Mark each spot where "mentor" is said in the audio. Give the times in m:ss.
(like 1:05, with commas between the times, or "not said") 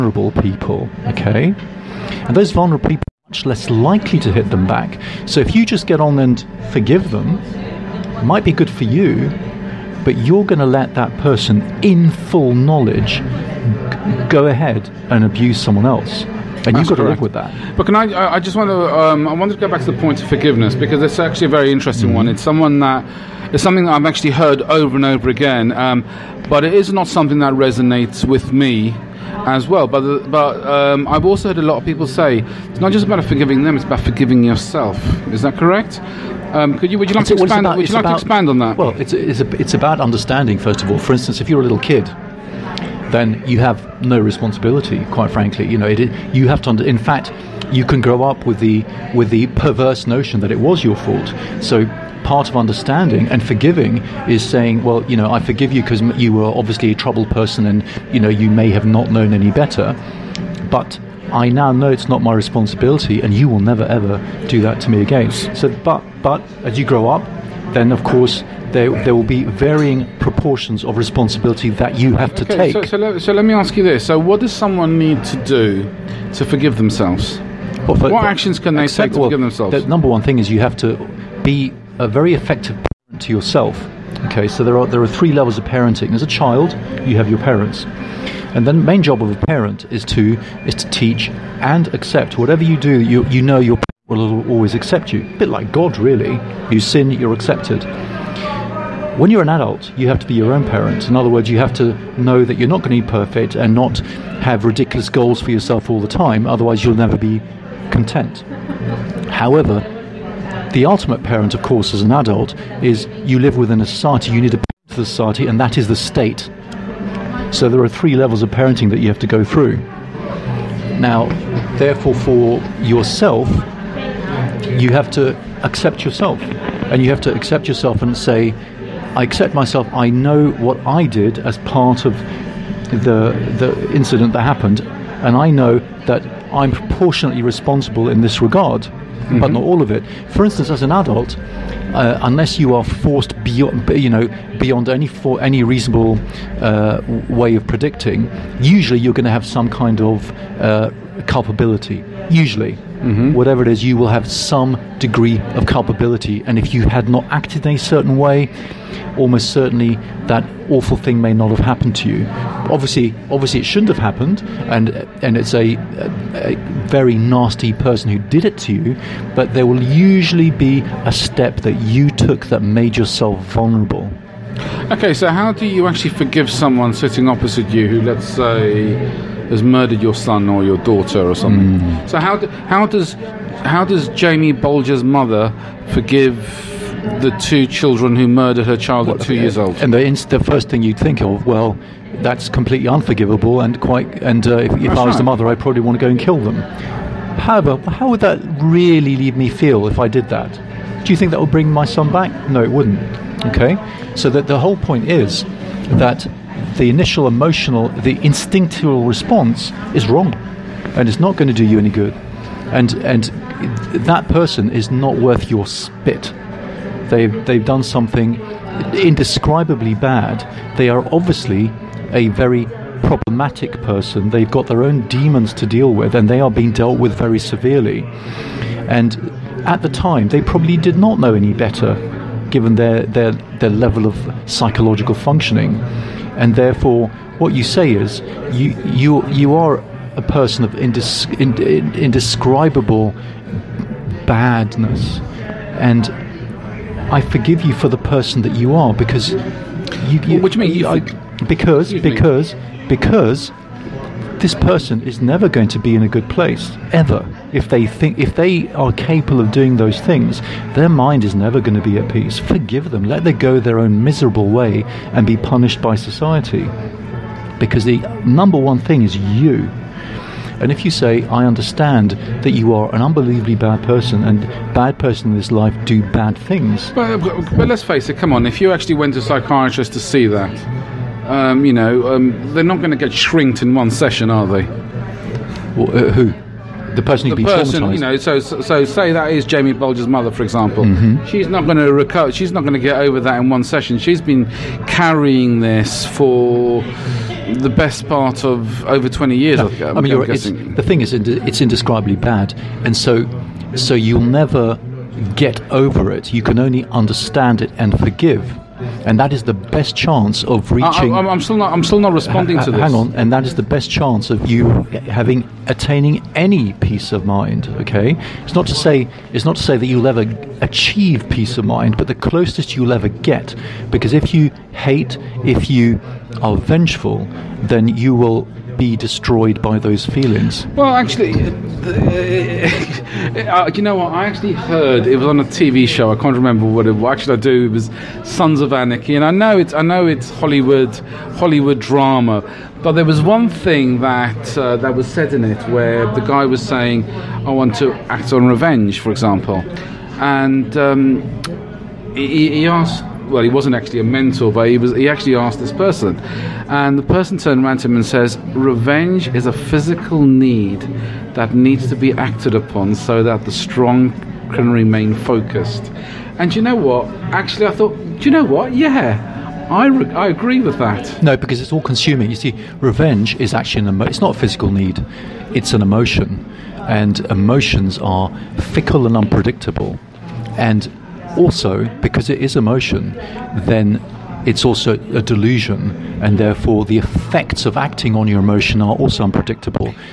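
5:54.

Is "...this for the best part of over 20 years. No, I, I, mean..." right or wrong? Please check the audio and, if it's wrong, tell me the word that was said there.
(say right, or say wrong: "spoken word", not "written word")
right.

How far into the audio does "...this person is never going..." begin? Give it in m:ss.
4:14.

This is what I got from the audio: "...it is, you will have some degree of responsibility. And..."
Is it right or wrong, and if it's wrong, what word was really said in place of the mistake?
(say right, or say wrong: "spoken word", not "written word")
wrong: "culpability", not "responsibility".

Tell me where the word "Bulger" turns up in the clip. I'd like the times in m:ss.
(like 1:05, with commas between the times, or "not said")
3:04, 4:49.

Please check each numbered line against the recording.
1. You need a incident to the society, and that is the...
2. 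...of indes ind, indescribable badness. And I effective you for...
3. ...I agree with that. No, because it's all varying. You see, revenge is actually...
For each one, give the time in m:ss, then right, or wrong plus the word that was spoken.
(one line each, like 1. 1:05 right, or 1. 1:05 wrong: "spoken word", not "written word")
1. 1:54 wrong: "parent", not "incident"
2. 4:00 wrong: "forgive", not "effective"
3. 6:10 wrong: "consuming", not "varying".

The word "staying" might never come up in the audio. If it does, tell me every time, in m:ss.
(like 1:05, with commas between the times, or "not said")
not said.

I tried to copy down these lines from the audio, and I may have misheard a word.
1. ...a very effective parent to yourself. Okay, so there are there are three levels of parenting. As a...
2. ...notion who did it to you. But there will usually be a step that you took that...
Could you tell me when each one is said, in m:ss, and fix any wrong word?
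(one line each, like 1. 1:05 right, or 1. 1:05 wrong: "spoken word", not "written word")
1. 1:21 right
2. 2:47 wrong: "person", not "notion".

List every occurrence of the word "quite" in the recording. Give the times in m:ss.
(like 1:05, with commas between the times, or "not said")
0:45, 3:13.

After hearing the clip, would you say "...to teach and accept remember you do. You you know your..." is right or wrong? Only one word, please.
wrong.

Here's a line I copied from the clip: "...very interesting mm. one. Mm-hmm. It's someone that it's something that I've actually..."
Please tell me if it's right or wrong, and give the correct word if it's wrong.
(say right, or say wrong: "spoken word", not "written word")
right.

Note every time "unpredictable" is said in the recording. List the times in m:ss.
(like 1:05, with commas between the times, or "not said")
6:19, 6:29.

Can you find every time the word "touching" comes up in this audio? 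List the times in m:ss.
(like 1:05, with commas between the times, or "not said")
not said.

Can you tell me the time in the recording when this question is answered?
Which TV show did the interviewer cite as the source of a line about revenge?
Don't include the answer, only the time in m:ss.
5:38.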